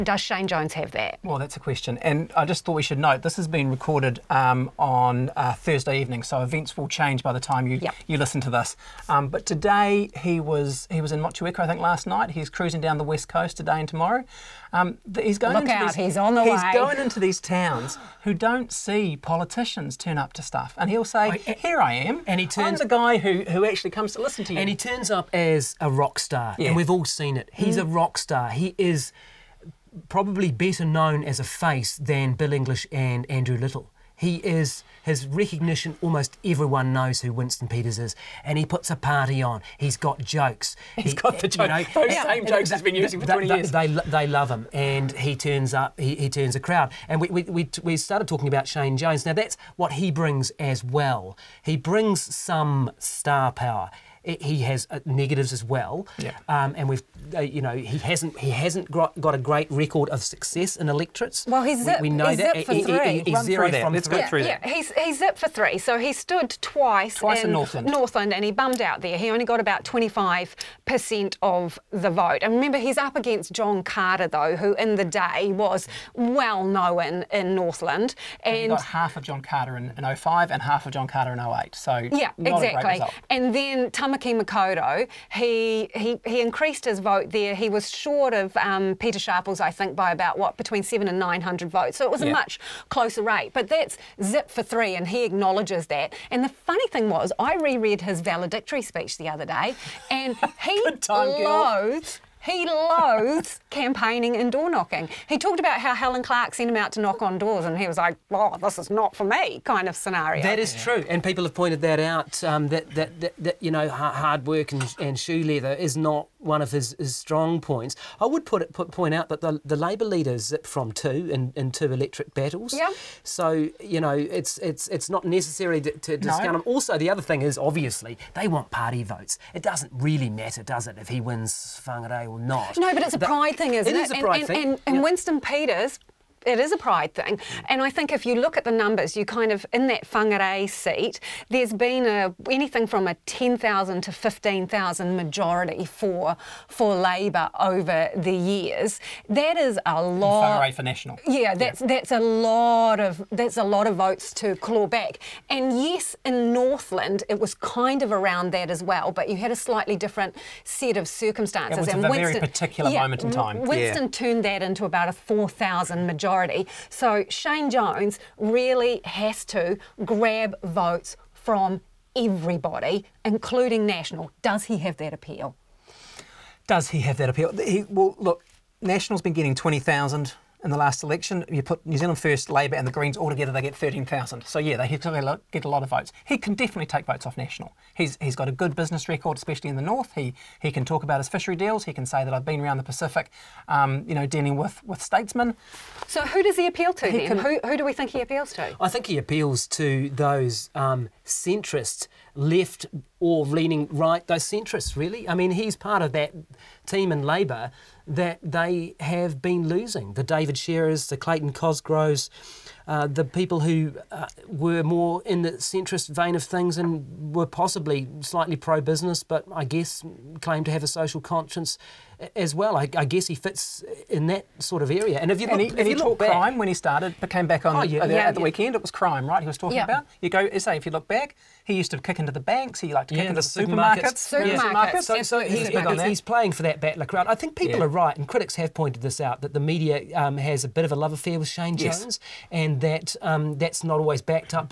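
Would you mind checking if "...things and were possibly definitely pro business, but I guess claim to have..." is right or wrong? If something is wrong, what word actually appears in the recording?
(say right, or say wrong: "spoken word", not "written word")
wrong: "slightly", not "definitely".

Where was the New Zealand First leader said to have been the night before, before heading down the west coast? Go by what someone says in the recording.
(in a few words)
Motueka.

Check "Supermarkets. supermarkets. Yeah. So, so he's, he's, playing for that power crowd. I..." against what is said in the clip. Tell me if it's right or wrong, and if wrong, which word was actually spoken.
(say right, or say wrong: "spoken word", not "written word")
wrong: "battler", not "power".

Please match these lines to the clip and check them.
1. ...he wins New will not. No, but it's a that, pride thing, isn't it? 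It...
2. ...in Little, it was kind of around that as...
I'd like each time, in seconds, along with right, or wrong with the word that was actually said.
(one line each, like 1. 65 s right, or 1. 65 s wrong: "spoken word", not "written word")
1. 131 s wrong: "Whangarei", not "New"
2. 156 s wrong: "Northland", not "Little".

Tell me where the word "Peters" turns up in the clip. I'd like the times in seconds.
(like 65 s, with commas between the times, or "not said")
37 s, 135 s.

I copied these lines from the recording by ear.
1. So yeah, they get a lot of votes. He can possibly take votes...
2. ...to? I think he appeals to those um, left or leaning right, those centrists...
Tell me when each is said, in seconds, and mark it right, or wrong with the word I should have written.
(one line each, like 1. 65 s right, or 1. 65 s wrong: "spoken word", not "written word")
1. 184 s wrong: "definitely", not "possibly"
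2. 198 s right.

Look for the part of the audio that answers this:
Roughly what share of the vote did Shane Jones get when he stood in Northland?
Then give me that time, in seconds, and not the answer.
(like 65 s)
69 s.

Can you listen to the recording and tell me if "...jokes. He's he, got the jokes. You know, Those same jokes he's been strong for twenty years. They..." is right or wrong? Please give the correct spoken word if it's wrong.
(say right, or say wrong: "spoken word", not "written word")
wrong: "using", not "strong".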